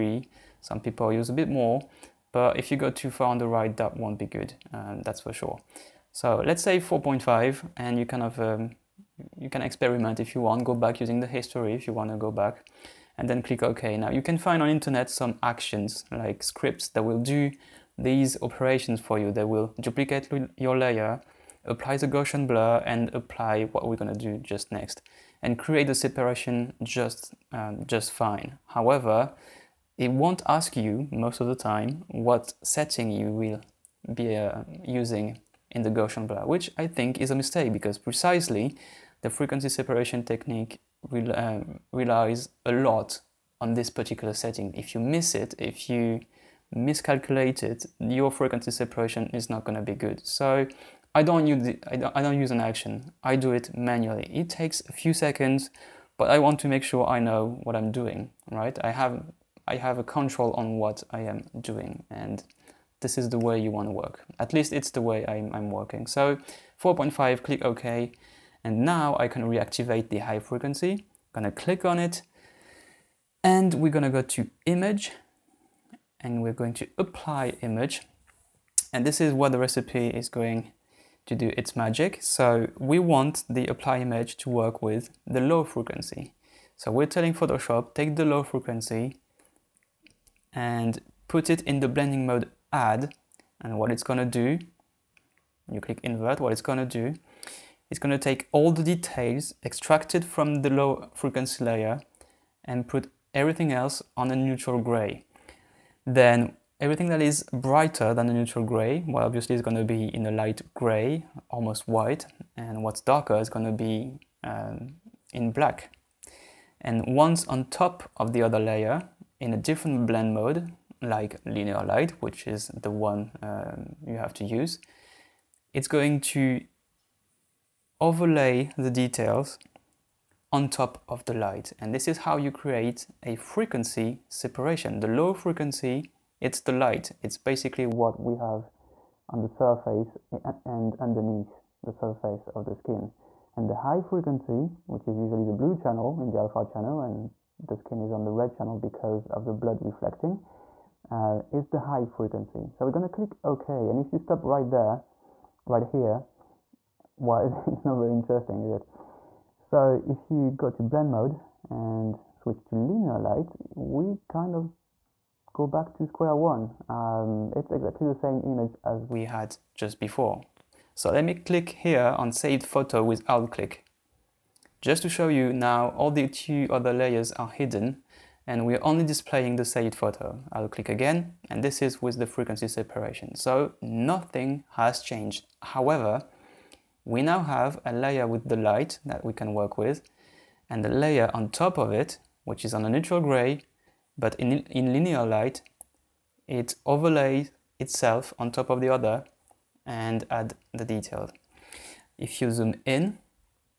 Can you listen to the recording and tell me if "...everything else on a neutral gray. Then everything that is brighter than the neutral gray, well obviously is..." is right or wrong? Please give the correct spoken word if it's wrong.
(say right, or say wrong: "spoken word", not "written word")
right.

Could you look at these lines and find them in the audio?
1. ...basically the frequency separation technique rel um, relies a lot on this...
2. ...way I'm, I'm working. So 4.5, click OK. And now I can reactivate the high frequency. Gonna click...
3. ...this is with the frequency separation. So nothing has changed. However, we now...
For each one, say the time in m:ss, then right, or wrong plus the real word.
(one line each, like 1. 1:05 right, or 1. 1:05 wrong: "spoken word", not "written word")
1. 0:37 wrong: "precisely", not "basically"
2. 1:05 right
3. 3:01 right.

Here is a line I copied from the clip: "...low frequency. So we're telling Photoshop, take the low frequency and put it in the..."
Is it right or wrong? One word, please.
right.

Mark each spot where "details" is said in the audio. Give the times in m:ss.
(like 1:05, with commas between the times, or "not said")
1:38, 2:08, 3:20.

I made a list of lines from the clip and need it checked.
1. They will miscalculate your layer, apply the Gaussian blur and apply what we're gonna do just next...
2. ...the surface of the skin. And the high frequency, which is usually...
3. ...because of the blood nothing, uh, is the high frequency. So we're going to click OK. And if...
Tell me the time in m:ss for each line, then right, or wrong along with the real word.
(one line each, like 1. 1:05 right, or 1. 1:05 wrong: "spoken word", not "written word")
1. 0:19 wrong: "duplicate", not "miscalculate"
2. 2:21 right
3. 2:28 wrong: "reflecting", not "nothing".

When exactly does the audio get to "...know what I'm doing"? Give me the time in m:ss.
0:57.